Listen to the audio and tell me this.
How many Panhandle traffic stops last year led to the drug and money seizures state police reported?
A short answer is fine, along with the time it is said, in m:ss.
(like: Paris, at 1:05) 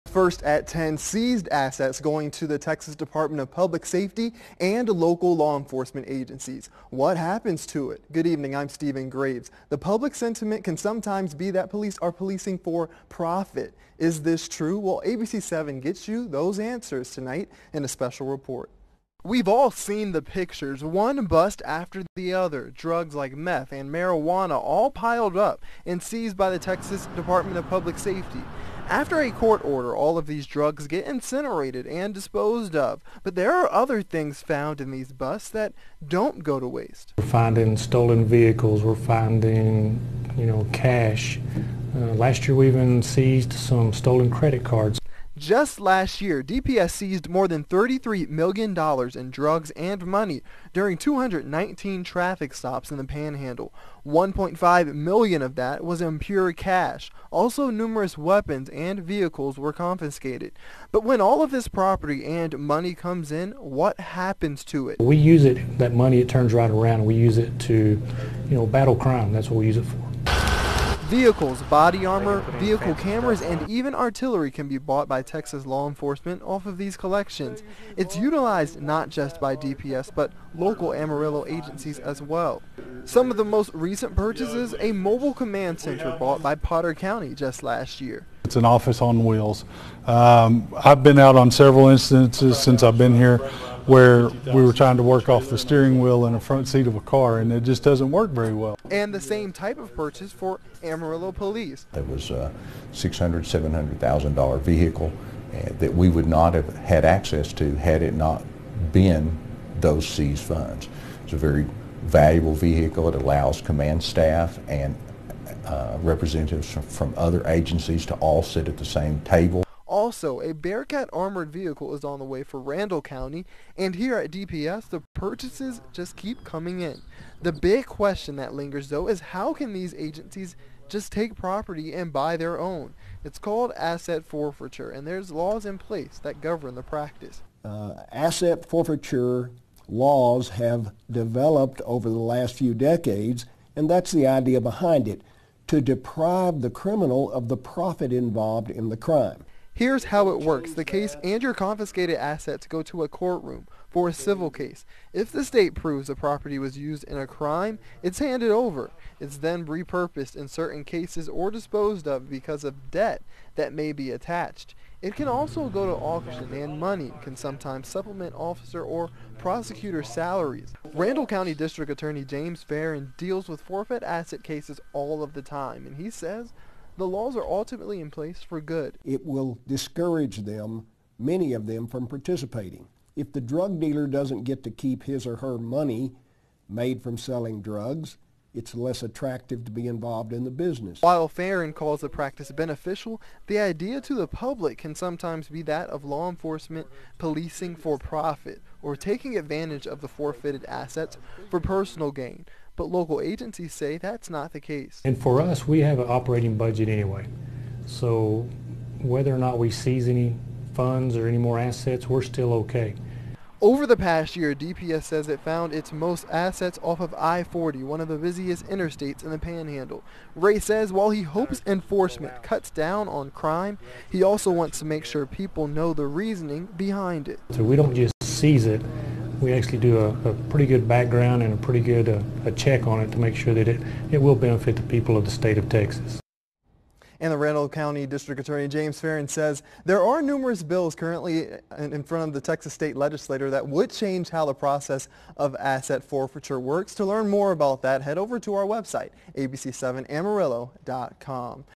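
219, at 0:50.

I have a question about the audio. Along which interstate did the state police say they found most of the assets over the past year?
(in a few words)
I-40.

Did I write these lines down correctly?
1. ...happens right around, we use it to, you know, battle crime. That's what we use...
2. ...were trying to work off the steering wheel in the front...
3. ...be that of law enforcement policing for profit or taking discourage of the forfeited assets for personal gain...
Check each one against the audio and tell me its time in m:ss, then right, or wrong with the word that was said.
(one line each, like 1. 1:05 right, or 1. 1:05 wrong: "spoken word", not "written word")
1. 1:06 wrong: "turns", not "happens"
2. 1:34 right
3. 3:15 wrong: "advantage", not "discourage".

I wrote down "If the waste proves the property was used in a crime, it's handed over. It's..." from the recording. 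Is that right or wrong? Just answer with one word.
wrong.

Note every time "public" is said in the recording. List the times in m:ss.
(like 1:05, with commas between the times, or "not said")
0:03, 0:09, 0:27, 3:14.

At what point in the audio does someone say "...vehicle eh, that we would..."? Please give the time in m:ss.
1:44.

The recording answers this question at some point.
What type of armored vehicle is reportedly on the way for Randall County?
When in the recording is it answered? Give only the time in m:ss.
2:00.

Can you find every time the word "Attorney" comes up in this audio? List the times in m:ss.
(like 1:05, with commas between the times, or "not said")
2:51, 3:58.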